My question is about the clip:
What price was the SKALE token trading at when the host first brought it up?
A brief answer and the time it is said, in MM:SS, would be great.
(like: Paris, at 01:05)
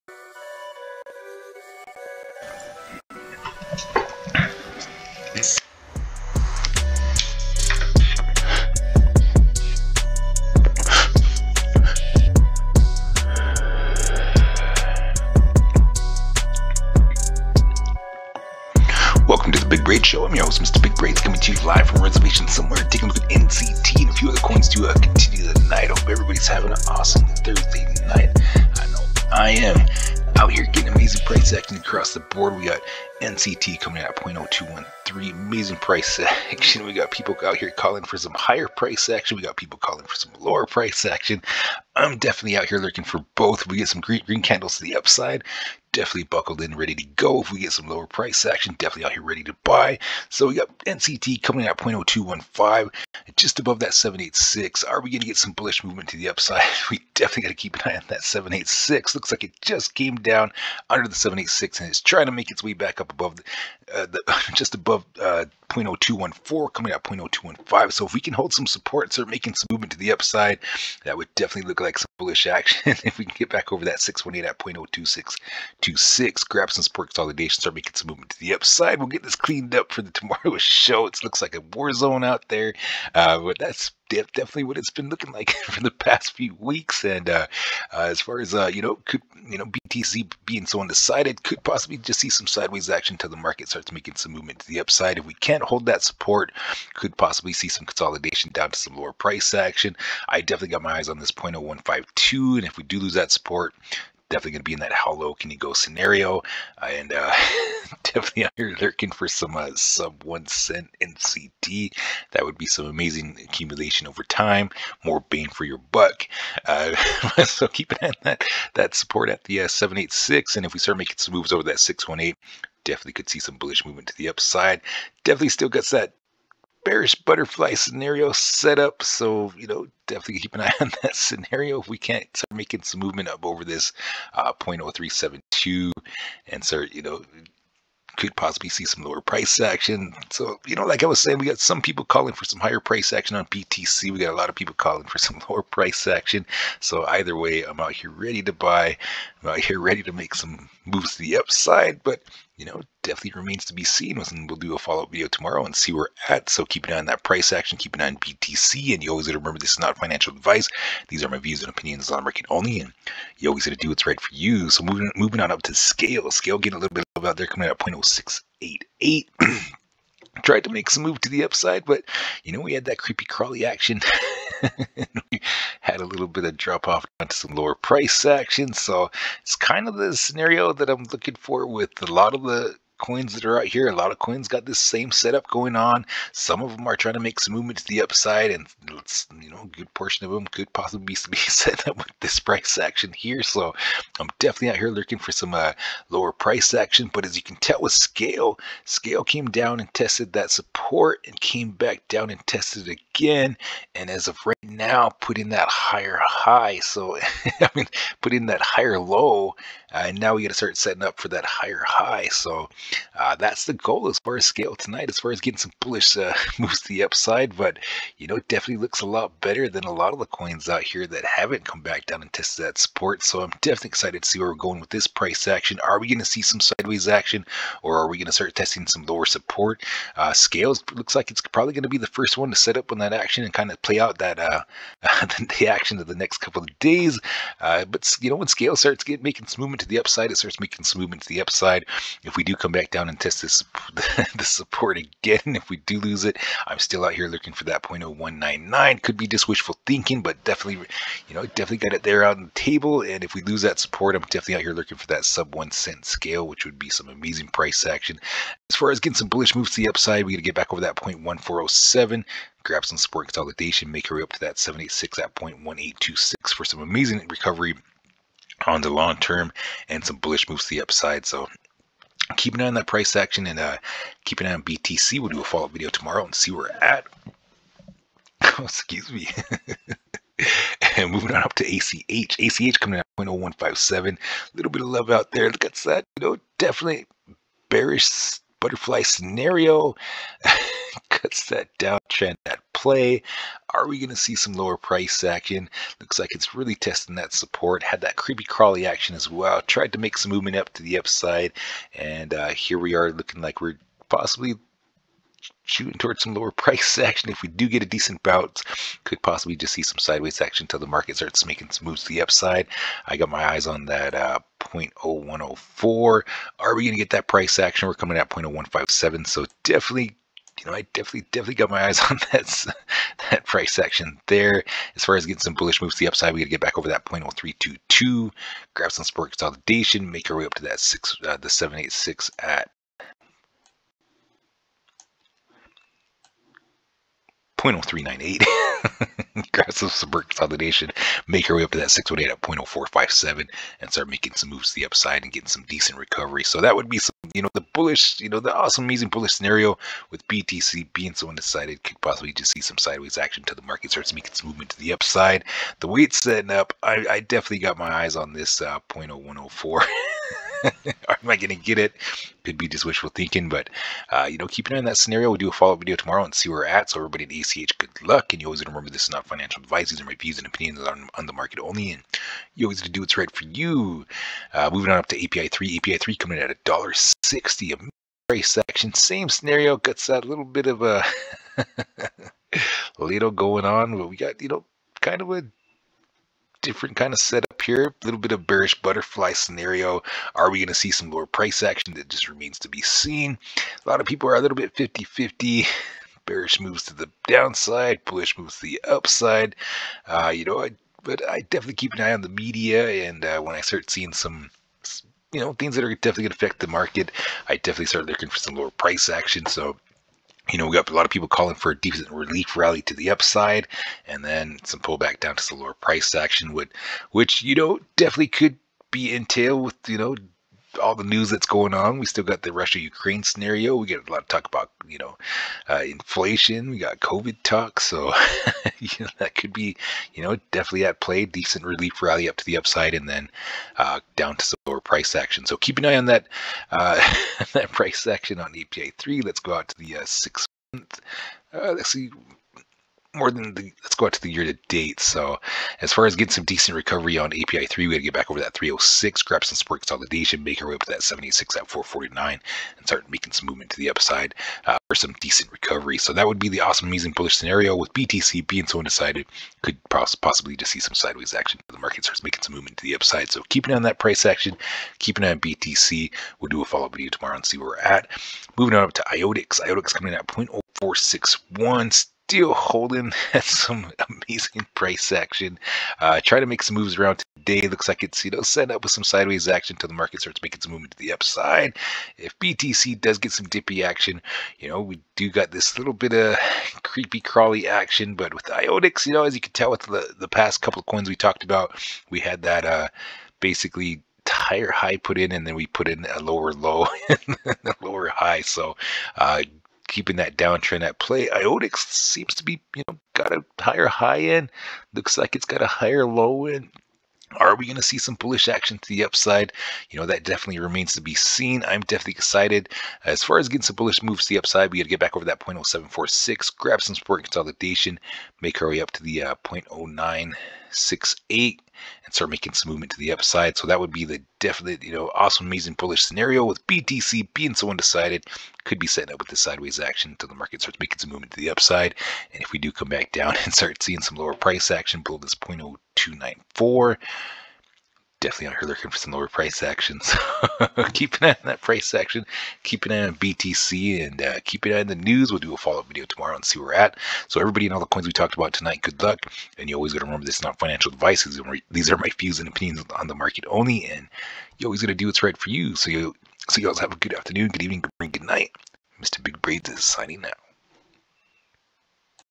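0.0688, at 02:47.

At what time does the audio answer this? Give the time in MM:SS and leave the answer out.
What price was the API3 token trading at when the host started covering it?
06:16.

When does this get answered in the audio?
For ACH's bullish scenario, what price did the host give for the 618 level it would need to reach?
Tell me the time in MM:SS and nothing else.
05:42.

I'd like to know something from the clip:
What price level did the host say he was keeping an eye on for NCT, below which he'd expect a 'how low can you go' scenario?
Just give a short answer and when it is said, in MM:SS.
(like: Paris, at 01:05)
0.0152, at 01:41.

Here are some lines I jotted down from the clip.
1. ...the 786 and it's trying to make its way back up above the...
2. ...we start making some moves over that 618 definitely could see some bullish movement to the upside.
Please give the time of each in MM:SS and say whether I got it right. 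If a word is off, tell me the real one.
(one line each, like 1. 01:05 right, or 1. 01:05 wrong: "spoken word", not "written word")
1. 01:01 right
2. 02:00 right.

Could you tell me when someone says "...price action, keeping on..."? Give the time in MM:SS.
07:43.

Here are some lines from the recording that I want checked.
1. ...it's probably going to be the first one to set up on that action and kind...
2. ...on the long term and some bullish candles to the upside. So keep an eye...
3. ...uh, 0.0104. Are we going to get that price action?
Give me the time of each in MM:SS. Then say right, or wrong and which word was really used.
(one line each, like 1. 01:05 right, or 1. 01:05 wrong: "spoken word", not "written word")
1. 03:51 right
2. 04:28 wrong: "moves", not "candles"
3. 05:14 right.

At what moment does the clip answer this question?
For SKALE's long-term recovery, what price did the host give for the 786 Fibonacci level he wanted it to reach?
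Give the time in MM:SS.
04:25.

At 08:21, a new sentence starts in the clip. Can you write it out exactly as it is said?
IoTeX seems to be, you know, got a higher high end.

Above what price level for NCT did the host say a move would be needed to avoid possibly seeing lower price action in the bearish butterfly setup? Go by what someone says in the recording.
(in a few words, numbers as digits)
0.0372.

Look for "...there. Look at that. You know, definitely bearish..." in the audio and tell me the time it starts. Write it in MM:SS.
04:45.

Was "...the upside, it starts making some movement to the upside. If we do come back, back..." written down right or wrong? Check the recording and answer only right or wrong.
right.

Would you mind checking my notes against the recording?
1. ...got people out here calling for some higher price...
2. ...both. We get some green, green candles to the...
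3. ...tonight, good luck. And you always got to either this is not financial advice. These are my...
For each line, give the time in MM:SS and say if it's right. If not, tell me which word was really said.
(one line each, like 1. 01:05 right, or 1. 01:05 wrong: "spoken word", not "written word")
1. 00:36 right
2. 00:43 right
3. 09:08 wrong: "remember", not "either".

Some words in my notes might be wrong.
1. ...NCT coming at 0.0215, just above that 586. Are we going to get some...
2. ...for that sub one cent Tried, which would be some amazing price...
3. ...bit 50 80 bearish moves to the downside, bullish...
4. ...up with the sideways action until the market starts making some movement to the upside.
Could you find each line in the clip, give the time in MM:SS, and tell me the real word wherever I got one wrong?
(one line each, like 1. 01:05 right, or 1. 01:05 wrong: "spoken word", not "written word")
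1. 00:50 wrong: "786", not "586"
2. 04:14 wrong: "SKALE", not "Tried"
3. 06:34 wrong: "50", not "80"
4. 08:49 right.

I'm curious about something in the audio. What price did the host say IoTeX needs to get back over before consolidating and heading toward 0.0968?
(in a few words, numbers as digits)
0.0746.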